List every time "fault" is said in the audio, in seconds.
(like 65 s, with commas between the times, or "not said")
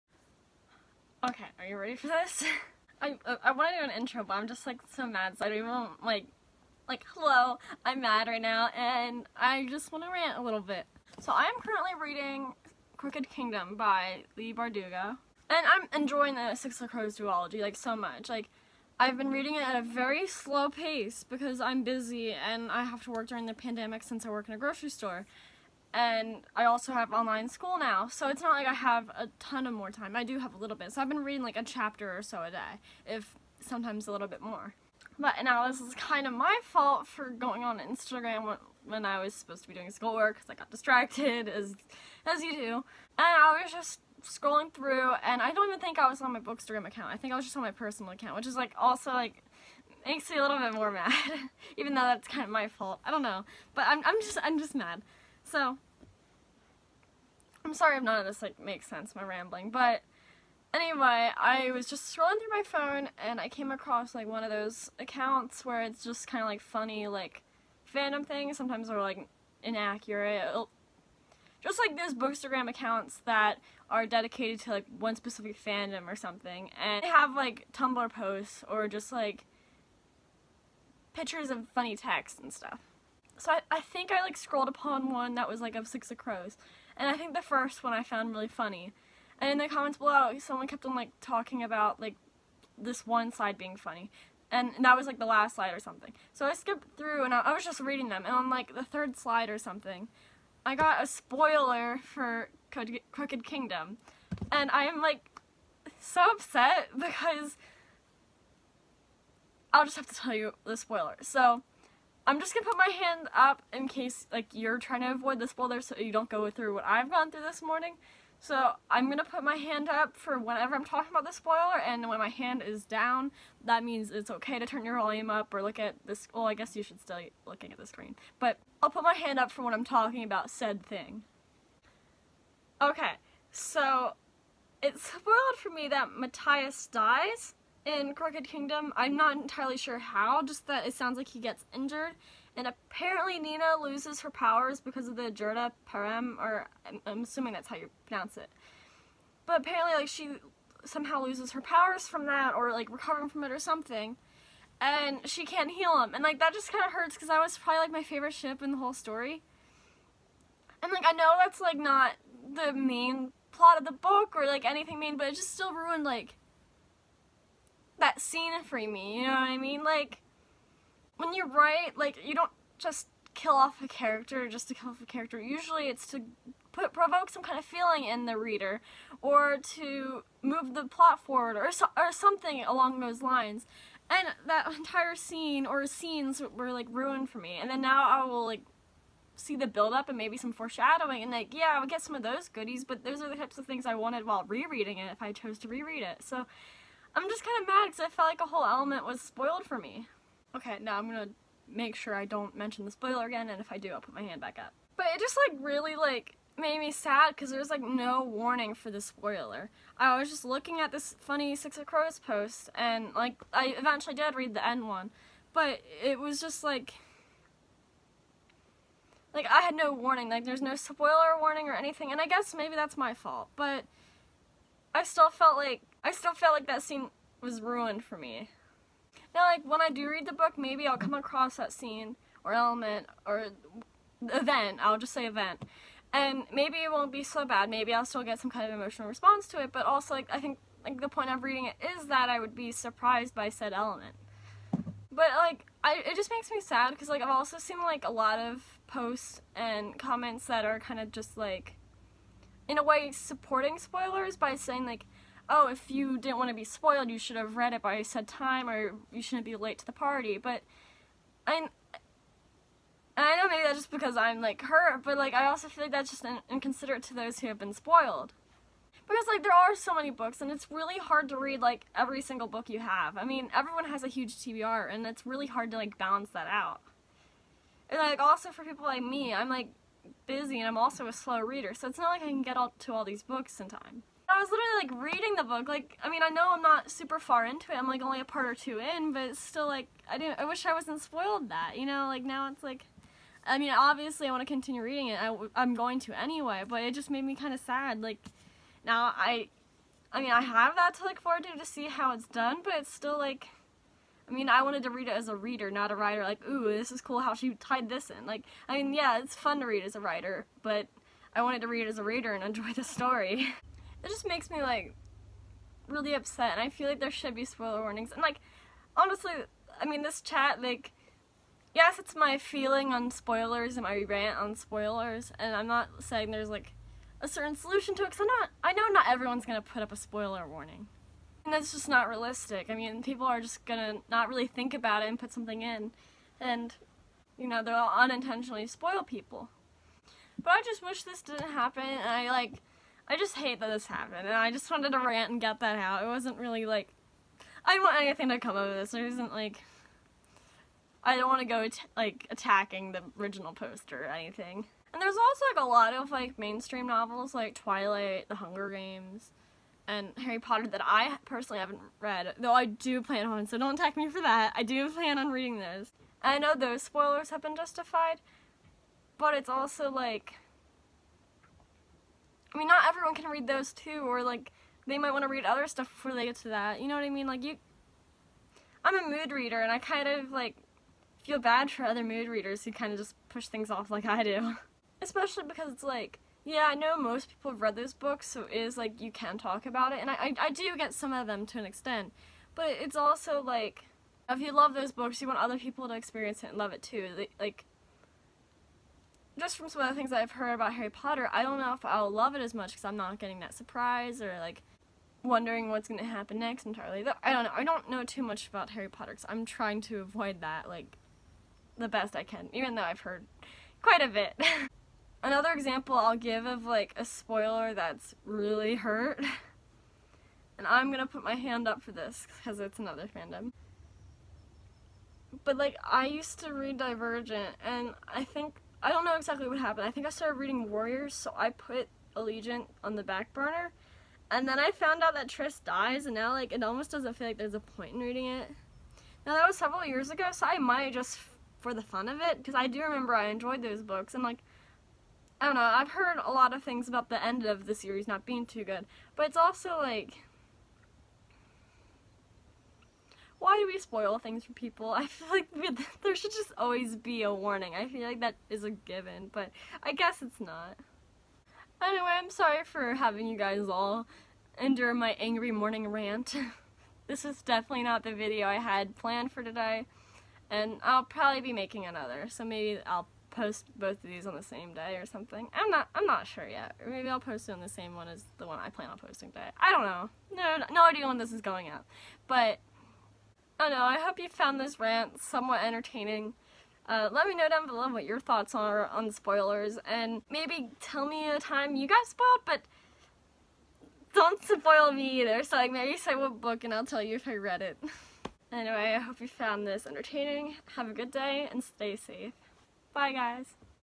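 36 s, 52 s, 223 s.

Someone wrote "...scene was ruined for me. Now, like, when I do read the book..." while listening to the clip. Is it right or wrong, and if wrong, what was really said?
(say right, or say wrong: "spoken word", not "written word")
right.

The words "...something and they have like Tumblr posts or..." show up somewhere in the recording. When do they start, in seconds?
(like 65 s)
76 s.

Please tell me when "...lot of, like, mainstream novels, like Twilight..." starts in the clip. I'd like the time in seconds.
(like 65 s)
355 s.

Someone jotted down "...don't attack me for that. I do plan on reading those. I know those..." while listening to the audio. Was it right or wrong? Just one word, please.
right.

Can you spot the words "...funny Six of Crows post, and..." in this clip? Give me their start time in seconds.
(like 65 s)
211 s.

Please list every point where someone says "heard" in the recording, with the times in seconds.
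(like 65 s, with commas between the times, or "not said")
400 s, 413 s, 445 s.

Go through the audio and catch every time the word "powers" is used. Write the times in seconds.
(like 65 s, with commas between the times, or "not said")
144 s, 151 s.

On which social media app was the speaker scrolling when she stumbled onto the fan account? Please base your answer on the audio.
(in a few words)
Instagram.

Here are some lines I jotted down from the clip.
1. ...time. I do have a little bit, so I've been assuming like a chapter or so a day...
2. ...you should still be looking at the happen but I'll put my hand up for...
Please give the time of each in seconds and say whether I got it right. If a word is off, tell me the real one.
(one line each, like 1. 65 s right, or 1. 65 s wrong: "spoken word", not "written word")
1. 29 s wrong: "reading", not "assuming"
2. 126 s wrong: "screen", not "happen".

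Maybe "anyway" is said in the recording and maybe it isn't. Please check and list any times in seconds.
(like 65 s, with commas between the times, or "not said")
60 s, 296 s, 461 s, 498 s.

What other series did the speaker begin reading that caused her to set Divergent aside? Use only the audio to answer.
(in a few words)
Warriors.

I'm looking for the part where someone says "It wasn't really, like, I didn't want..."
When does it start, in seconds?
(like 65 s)
346 s.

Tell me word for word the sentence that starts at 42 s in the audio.
And I was just scrolling through, and I don't even think I was on my Bookstagram account.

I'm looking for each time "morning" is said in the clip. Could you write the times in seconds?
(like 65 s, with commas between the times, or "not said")
117 s, 465 s.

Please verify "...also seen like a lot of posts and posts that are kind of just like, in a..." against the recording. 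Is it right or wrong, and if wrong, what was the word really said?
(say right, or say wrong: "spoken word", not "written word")
wrong: "comments", not "posts".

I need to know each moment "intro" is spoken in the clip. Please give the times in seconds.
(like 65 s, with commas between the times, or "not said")
3 s.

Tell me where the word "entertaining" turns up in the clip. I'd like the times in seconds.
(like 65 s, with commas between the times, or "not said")
485 s, 499 s.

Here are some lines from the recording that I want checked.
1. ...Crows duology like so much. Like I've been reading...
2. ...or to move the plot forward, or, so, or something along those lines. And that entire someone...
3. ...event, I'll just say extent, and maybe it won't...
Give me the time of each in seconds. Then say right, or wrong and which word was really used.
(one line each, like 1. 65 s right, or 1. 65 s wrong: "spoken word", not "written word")
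1. 16 s right
2. 179 s wrong: "scene", not "someone"
3. 234 s wrong: "event", not "extent".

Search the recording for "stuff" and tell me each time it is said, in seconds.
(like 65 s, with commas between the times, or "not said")
82 s, 375 s.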